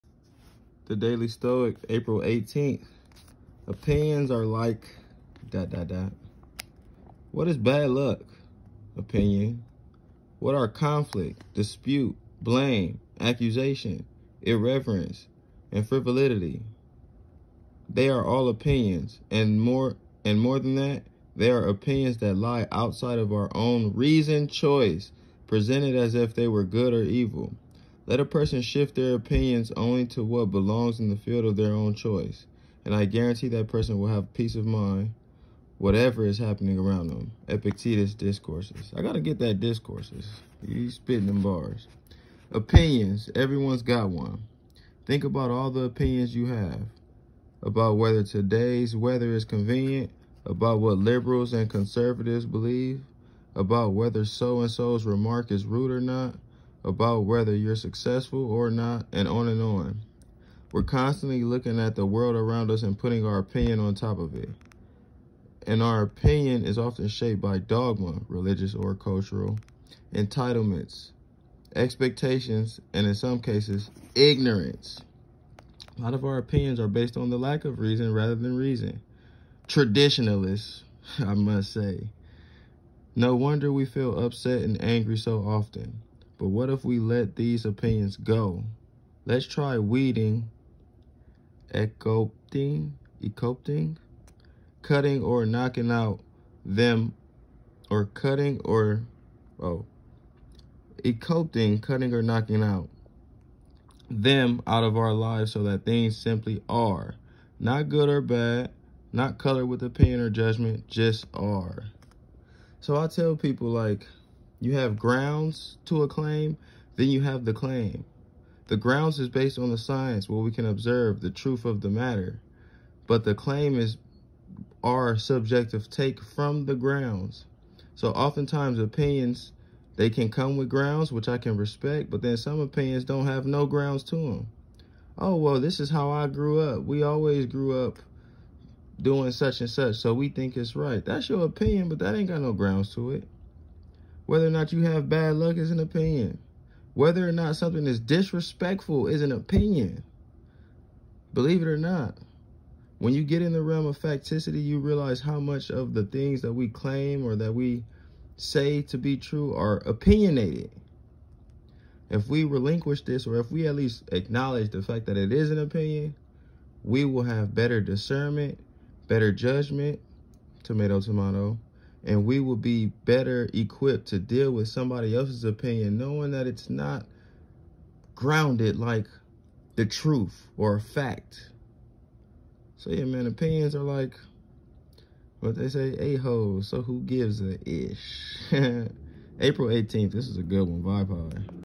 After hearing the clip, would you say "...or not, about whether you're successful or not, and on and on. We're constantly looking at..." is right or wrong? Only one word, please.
right.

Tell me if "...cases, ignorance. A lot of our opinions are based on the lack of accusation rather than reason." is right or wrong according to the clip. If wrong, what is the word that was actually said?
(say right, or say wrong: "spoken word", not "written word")
wrong: "reason", not "accusation".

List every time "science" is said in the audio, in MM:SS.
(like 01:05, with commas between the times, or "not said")
01:59.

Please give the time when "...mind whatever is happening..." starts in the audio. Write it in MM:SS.
00:34.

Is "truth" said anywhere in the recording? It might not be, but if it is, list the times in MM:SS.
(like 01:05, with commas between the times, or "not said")
02:01, 02:59.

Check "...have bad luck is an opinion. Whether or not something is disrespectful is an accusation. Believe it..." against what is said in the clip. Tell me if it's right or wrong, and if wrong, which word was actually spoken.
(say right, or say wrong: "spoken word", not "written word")
wrong: "opinion", not "accusation".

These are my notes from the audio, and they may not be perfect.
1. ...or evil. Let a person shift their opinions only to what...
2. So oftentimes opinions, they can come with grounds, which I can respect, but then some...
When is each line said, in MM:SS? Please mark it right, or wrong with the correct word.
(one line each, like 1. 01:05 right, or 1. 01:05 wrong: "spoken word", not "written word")
1. 00:26 right
2. 02:07 right.